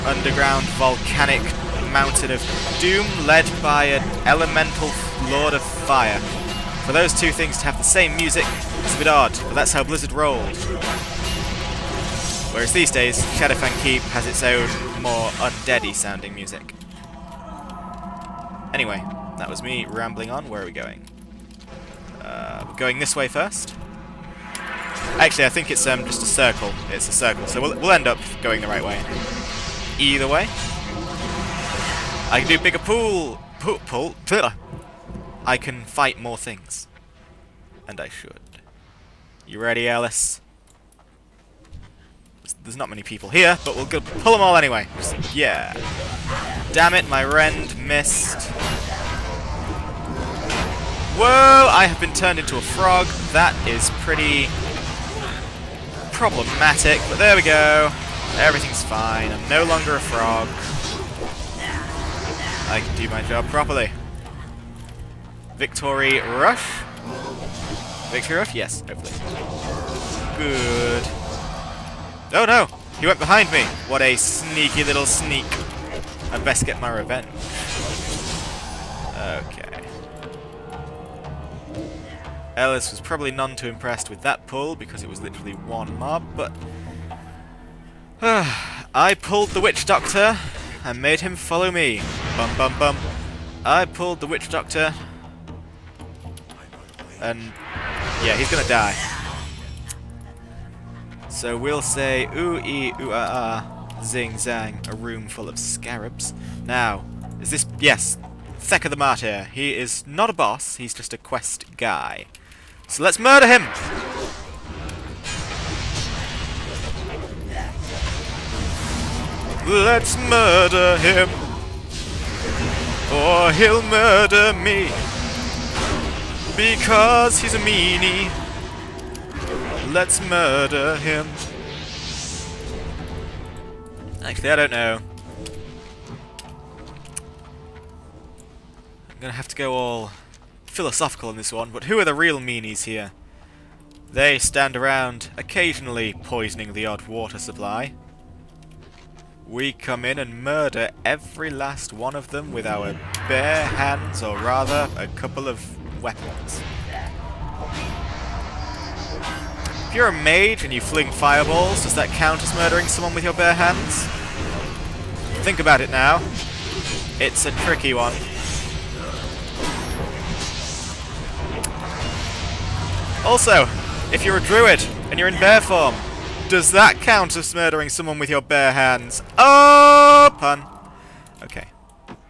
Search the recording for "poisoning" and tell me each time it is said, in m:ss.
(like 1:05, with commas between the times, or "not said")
2:26.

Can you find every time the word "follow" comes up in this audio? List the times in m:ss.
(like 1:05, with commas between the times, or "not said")
1:31.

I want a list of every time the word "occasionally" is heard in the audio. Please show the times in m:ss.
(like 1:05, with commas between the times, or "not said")
2:25.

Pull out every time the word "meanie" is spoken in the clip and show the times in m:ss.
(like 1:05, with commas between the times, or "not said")
2:07, 2:22.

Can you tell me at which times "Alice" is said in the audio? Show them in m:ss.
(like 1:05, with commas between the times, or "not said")
0:39.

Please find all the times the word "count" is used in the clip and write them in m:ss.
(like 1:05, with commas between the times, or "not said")
2:42, 2:56.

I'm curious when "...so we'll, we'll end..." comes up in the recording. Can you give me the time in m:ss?
0:27.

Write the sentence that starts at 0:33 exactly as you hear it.
Pool, pool, I can fight more things.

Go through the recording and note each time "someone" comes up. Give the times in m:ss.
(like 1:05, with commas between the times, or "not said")
2:42, 2:57.